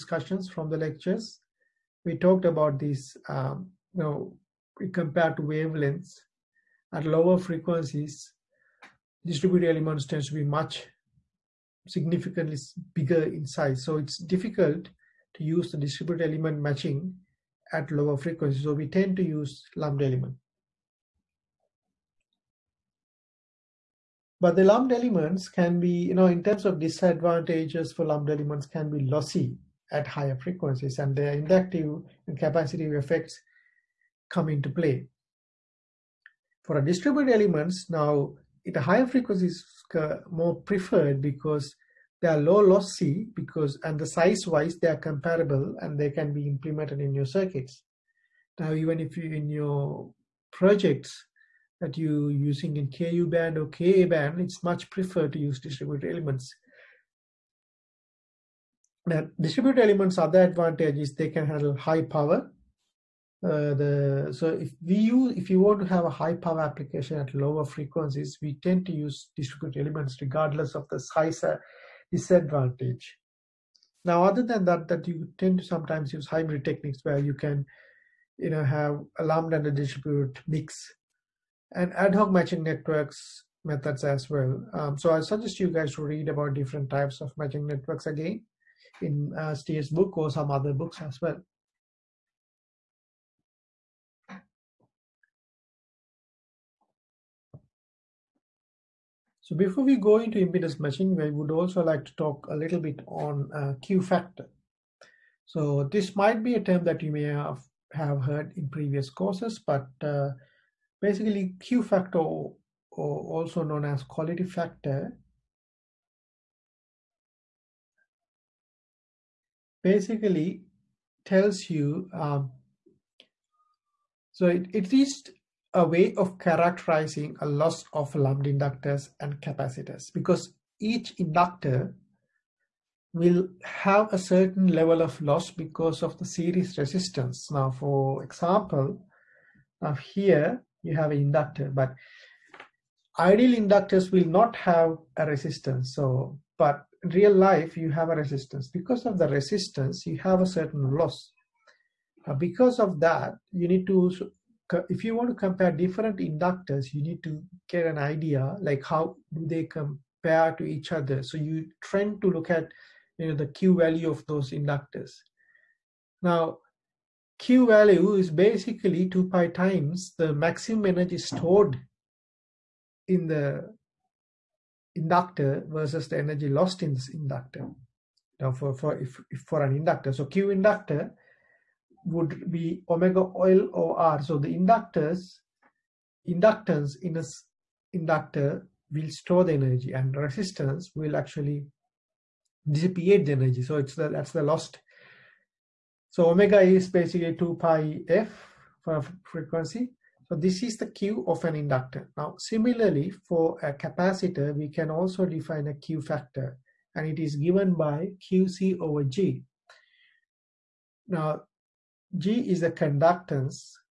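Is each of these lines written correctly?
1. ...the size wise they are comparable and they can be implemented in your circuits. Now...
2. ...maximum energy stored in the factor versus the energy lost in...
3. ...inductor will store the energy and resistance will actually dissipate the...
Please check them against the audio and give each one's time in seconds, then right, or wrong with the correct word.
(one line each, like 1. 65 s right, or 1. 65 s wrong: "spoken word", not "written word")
1. 43 s right
2. 170 s wrong: "inductor", not "factor"
3. 187 s right.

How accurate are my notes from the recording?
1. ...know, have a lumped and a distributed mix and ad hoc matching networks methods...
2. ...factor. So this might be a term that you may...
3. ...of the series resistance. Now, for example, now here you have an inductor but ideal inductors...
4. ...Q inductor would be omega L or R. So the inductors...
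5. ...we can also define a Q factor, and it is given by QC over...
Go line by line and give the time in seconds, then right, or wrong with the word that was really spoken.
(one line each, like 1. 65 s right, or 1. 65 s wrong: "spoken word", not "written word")
1. 78 s right
2. 104 s right
3. 136 s right
4. 180 s right
5. 204 s right.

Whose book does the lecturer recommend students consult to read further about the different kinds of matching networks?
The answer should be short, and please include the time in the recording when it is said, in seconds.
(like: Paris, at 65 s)
Steer's, at 89 s.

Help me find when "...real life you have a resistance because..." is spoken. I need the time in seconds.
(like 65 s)
147 s.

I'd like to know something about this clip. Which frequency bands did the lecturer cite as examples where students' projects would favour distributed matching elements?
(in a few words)
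KU band or KA band.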